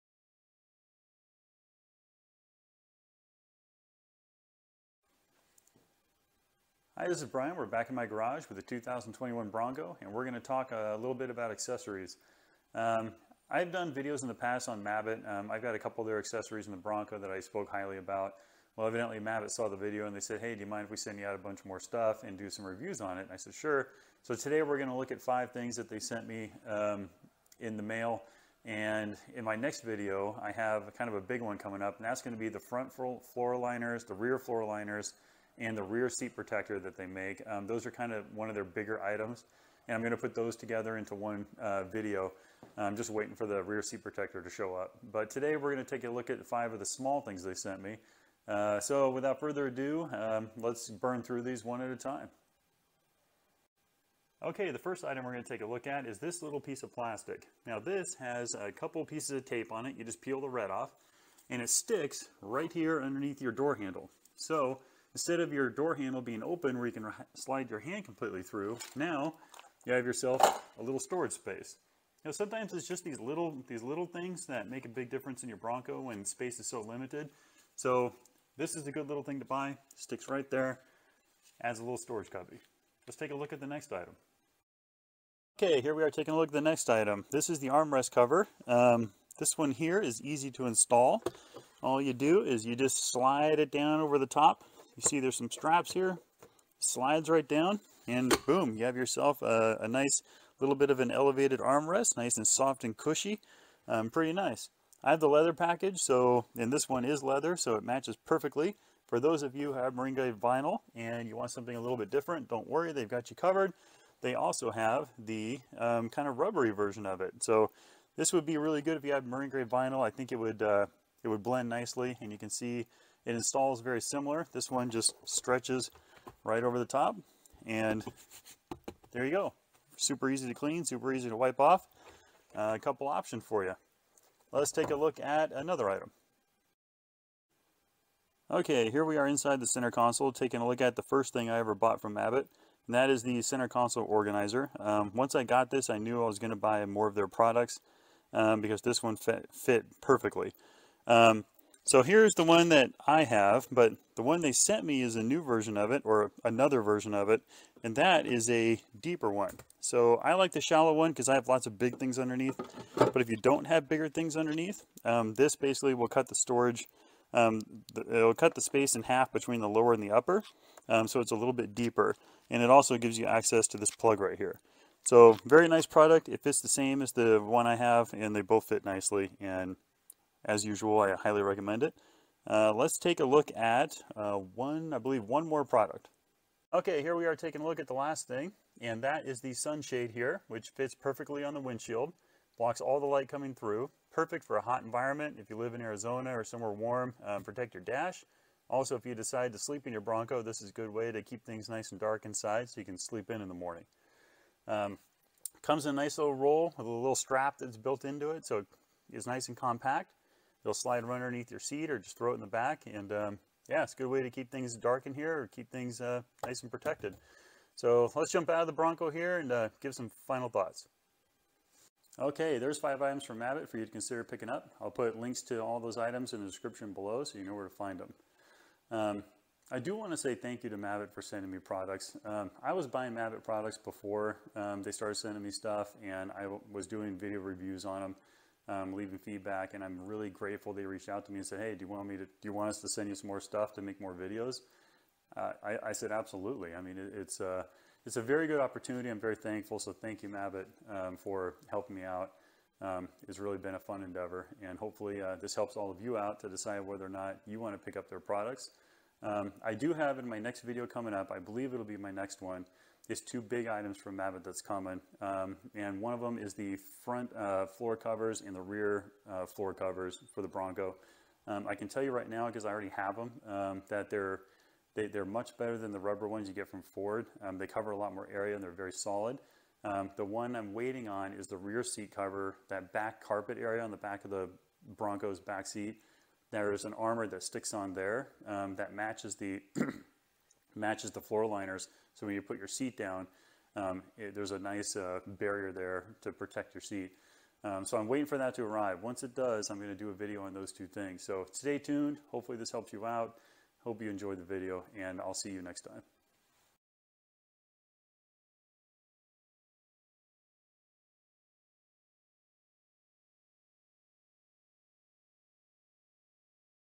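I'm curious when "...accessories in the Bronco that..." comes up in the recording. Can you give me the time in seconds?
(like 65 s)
16 s.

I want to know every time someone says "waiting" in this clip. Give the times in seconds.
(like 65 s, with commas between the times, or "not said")
43 s, 280 s, 298 s.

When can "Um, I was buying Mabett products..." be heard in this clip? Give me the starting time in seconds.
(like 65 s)
232 s.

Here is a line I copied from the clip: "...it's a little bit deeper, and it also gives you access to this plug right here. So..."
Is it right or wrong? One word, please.
right.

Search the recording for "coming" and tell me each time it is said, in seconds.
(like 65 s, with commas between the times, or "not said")
31 s, 193 s, 260 s.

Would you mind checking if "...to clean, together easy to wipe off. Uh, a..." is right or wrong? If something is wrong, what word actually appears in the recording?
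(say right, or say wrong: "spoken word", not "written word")
wrong: "super", not "together".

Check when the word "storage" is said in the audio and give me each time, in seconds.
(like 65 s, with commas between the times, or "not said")
71 s, 81 s, 166 s.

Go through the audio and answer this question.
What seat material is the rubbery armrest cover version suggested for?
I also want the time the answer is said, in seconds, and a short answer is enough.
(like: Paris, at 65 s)
marine grade vinyl, at 119 s.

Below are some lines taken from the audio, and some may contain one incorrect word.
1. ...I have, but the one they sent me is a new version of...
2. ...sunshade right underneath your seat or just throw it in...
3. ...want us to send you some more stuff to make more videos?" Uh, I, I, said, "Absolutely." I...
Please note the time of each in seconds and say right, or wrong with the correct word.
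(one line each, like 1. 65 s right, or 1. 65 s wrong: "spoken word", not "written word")
1. 153 s right
2. 210 s wrong: "slide", not "sunshade"
3. 242 s right.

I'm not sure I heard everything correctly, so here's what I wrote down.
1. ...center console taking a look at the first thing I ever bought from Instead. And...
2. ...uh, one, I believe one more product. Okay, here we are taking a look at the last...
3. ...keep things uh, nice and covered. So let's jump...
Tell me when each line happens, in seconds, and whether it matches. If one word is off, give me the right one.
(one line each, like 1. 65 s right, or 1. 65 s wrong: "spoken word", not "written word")
1. 139 s wrong: "Mabett", not "Instead"
2. 184 s right
3. 215 s wrong: "protected", not "covered".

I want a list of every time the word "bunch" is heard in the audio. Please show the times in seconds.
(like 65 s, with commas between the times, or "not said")
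21 s.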